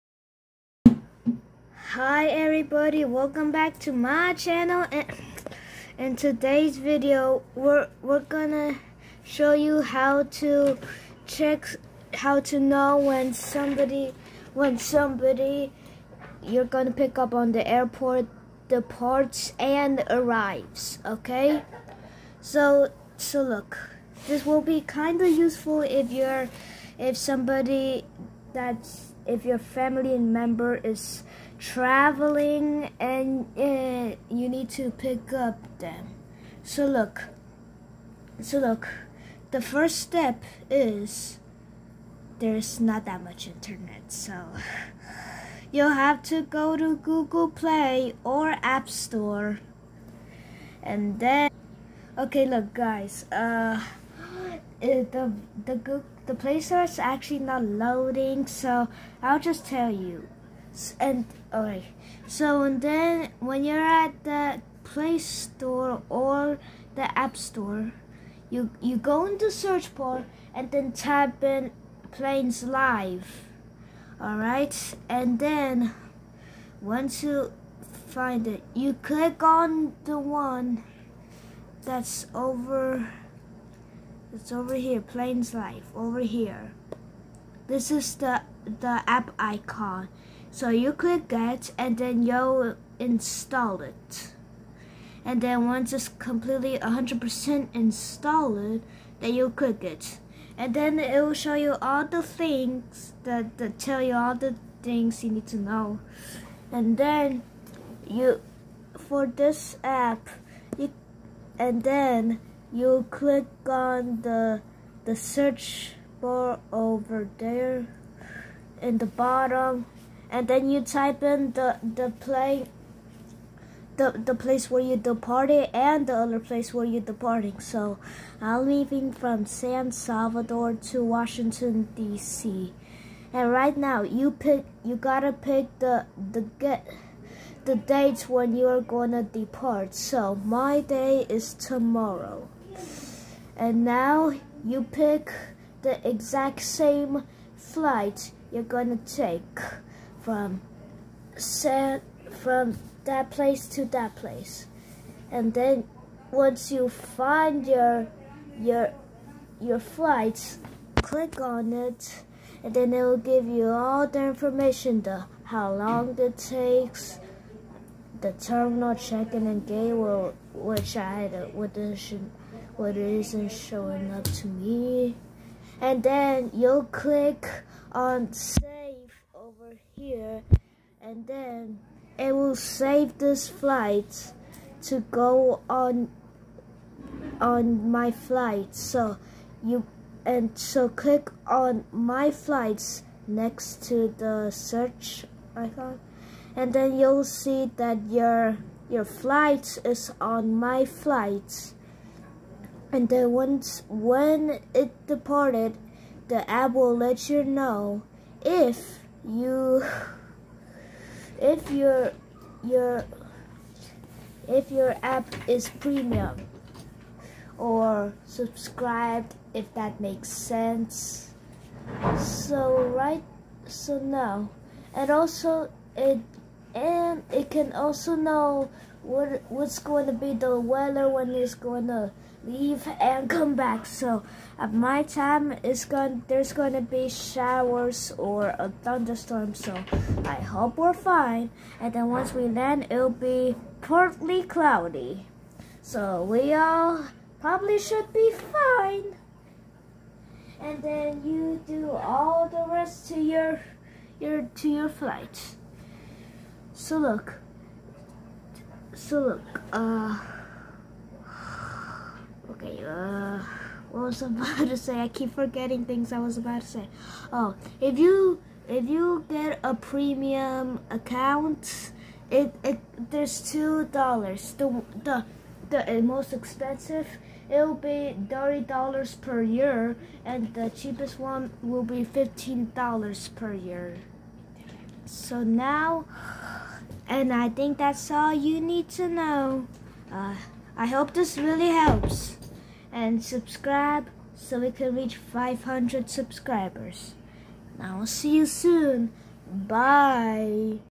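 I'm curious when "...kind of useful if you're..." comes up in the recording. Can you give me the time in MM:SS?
00:24.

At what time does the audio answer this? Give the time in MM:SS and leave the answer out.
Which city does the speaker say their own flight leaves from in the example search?
02:09.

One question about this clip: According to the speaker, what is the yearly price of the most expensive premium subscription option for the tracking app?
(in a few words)
$30 per year.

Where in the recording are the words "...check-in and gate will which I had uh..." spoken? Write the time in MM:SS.
02:48.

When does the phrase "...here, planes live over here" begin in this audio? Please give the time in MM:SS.
01:24.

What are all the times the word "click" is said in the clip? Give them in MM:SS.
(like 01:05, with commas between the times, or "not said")
01:19, 01:30, 01:39, 01:53, 02:41, 02:56, 03:10.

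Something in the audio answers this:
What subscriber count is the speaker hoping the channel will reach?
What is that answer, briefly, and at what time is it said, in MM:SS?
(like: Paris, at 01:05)
500, at 04:55.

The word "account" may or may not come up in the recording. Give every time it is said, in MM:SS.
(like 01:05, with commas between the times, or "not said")
04:30.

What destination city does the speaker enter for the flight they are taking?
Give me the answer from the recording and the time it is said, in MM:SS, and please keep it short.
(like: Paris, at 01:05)
Washington D.C., at 02:11.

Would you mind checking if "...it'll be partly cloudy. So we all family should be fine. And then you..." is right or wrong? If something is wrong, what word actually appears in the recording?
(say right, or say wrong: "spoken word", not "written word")
wrong: "probably", not "family".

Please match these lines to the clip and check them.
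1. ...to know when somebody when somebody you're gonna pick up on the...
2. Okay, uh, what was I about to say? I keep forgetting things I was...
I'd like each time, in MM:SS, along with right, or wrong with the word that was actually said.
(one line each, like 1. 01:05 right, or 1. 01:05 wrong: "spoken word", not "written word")
1. 00:12 right
2. 04:22 right.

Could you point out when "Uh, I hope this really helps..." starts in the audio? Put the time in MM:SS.
04:50.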